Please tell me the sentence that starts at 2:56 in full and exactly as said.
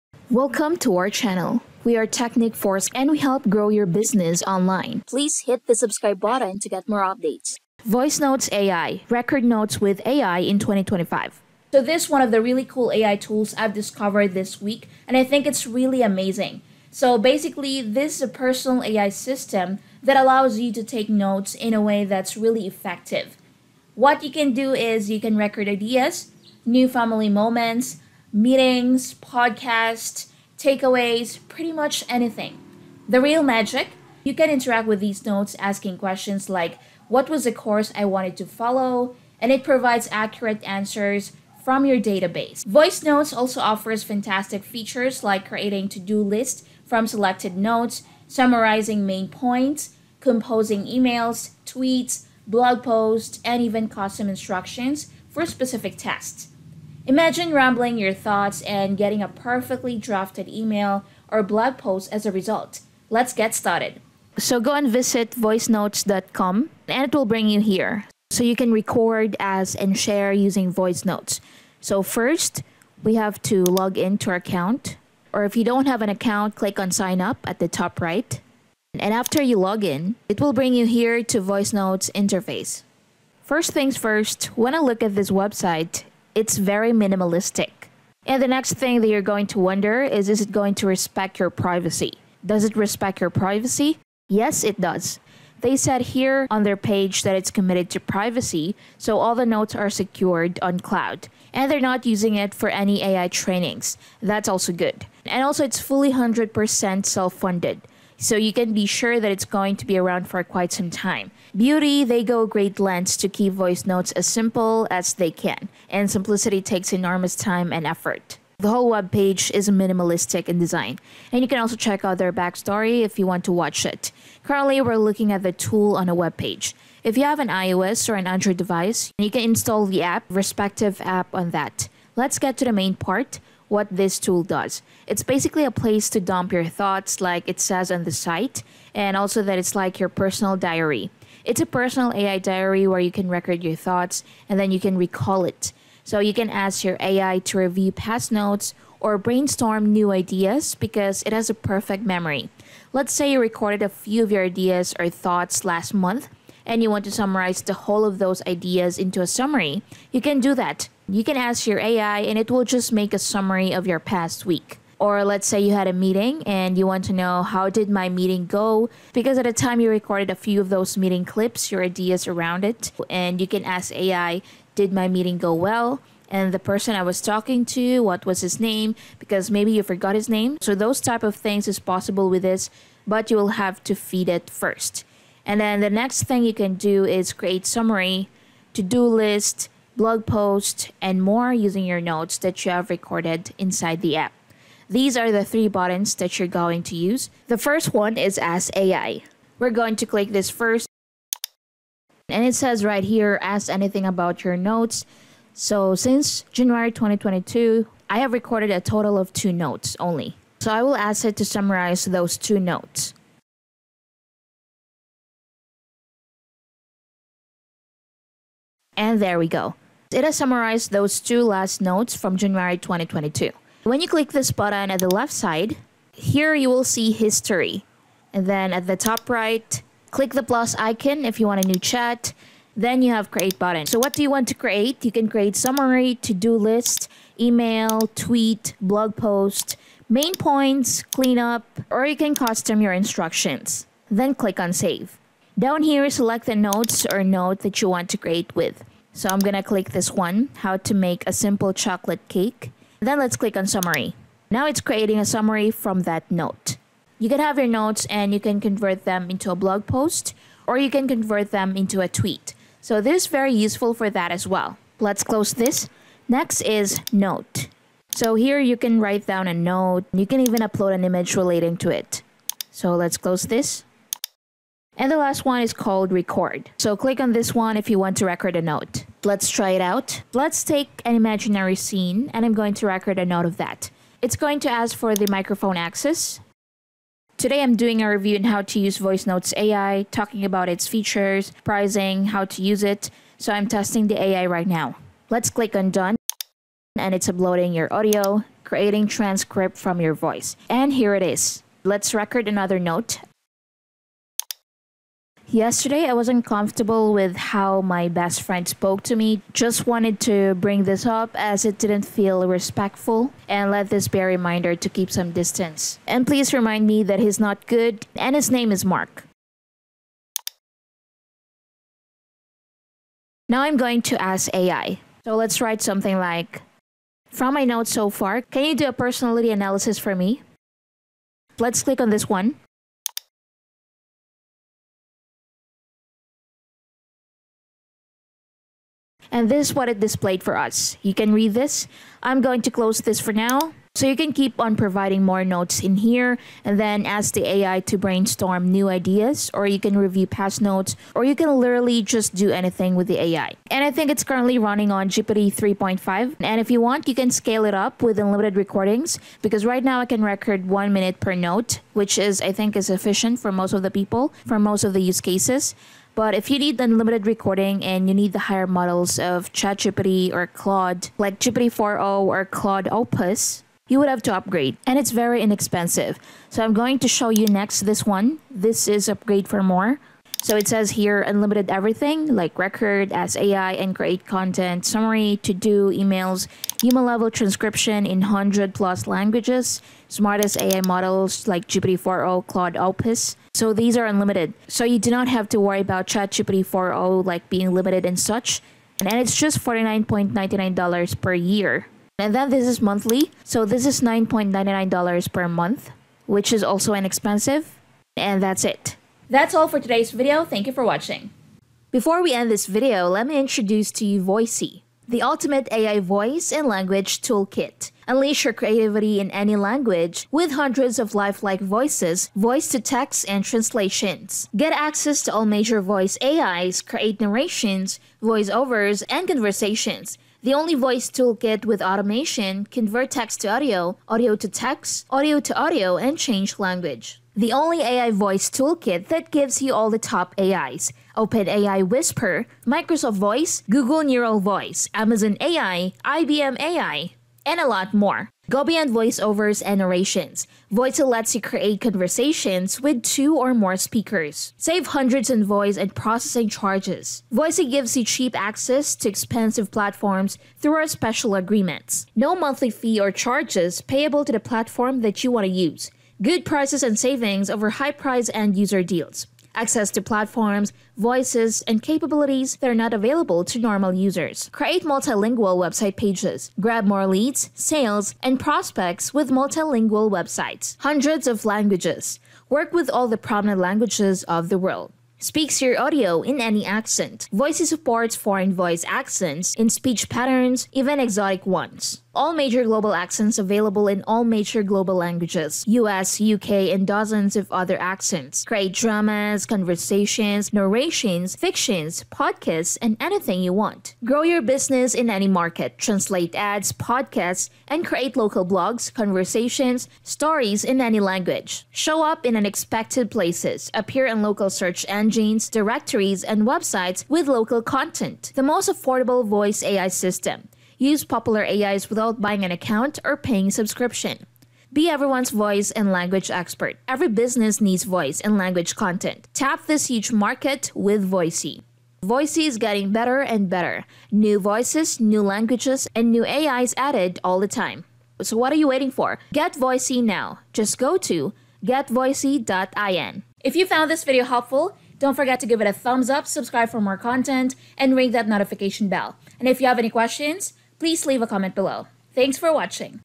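and the person I was talking to, what was his name, because maybe you forgot his name.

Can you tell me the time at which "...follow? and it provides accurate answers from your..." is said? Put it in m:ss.
0:38.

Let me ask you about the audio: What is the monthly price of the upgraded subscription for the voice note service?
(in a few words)
$9.99.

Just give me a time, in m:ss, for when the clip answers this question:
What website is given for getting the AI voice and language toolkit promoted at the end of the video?
9:01.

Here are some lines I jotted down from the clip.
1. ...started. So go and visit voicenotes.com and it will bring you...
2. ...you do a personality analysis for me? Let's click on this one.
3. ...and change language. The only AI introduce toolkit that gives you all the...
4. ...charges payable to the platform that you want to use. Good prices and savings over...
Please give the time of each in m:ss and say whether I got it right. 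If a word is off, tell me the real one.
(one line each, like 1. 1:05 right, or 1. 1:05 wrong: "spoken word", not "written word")
1. 1:03 right
2. 5:28 right
3. 7:15 wrong: "voice", not "introduce"
4. 7:43 right.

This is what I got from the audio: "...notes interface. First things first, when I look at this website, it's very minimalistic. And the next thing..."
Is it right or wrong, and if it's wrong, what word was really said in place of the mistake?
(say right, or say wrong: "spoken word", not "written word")
right.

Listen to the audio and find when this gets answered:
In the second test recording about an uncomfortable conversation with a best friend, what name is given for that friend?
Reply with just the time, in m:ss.
5:18.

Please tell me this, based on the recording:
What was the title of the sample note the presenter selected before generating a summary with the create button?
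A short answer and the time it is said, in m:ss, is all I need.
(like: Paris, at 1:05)
How to make a simple chocolate cake, at 4:10.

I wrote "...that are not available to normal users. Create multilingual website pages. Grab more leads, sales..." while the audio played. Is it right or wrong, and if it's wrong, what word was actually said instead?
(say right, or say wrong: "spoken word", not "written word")
right.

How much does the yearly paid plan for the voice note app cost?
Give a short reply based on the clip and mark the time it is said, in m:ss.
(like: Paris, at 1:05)
$49.99, at 6:39.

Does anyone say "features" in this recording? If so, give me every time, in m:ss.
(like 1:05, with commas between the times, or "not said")
0:44, 4:50.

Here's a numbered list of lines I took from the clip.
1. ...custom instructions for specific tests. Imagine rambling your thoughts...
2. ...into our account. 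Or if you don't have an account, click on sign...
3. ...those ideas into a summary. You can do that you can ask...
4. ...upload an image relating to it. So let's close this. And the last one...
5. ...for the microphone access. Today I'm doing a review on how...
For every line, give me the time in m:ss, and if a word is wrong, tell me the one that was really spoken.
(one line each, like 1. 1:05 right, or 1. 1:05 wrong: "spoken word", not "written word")
1. 0:53 right
2. 1:13 right
3. 2:38 right
4. 4:30 right
5. 4:44 right.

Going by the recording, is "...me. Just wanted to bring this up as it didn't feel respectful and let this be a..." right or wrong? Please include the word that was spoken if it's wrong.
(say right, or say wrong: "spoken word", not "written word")
right.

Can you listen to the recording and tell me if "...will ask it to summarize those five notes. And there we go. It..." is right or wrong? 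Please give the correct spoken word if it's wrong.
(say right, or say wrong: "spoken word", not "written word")
wrong: "two", not "five".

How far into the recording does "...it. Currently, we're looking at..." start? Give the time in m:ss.
2:03.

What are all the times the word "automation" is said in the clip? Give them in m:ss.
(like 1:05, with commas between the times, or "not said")
7:11.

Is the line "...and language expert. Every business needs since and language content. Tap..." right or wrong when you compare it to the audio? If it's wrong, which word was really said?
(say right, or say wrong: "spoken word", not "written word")
wrong: "voice", not "since".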